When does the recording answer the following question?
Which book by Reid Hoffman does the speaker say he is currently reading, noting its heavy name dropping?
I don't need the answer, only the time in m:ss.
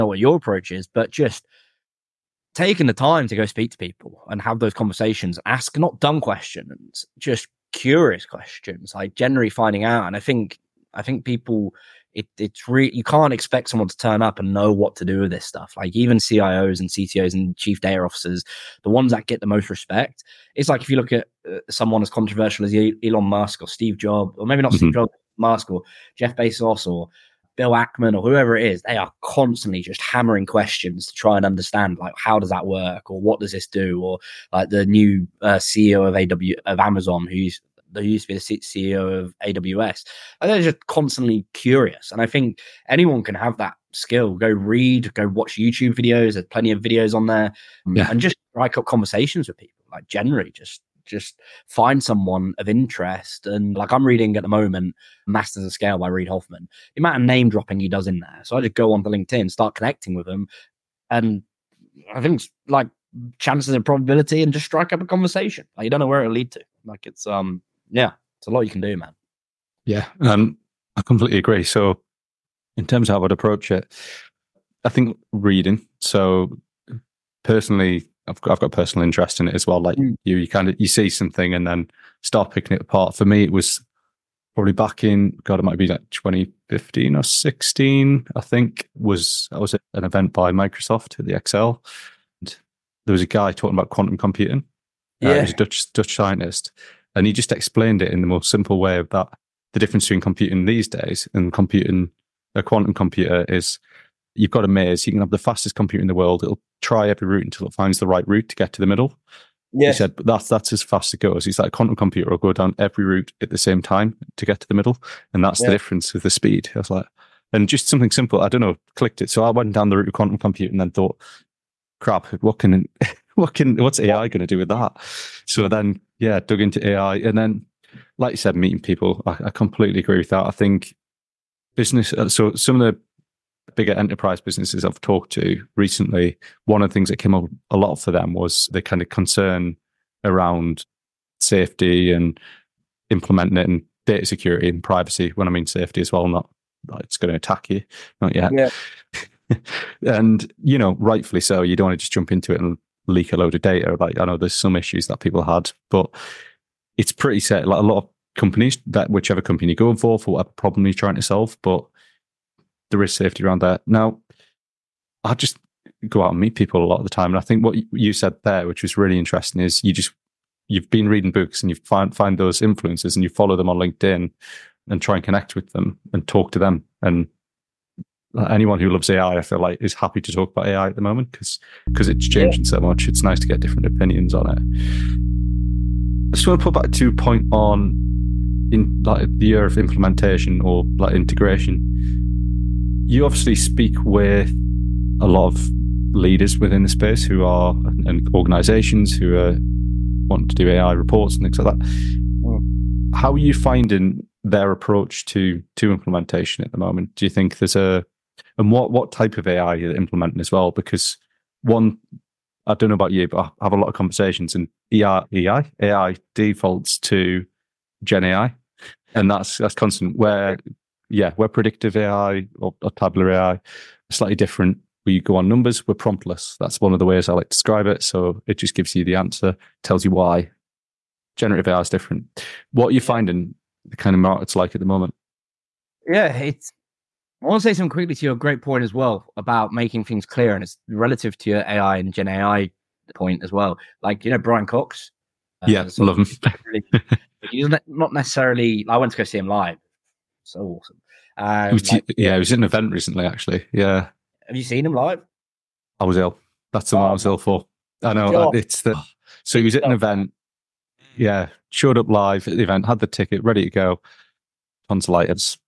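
0:55.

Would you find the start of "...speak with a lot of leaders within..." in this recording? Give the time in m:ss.
3:13.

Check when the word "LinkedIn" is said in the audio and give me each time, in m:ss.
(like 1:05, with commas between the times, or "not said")
0:59, 2:53.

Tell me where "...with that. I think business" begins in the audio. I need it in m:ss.
2:10.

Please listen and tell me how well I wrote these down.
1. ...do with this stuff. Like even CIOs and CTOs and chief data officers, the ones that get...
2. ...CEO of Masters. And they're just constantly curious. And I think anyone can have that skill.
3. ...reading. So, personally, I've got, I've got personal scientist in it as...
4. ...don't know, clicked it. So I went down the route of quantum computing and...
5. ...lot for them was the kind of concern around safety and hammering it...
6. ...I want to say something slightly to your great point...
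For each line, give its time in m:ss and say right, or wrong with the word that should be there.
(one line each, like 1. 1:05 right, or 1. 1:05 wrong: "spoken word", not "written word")
1. 0:15 right
2. 0:38 wrong: "AWS", not "Masters"
3. 1:15 wrong: "interest", not "scientist"
4. 1:58 right
5. 2:17 wrong: "implementing", not "hammering"
6. 3:57 wrong: "quickly", not "slightly".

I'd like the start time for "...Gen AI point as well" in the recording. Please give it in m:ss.
4:02.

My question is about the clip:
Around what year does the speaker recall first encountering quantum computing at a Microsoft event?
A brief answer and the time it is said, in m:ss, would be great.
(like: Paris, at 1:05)
2015, at 1:26.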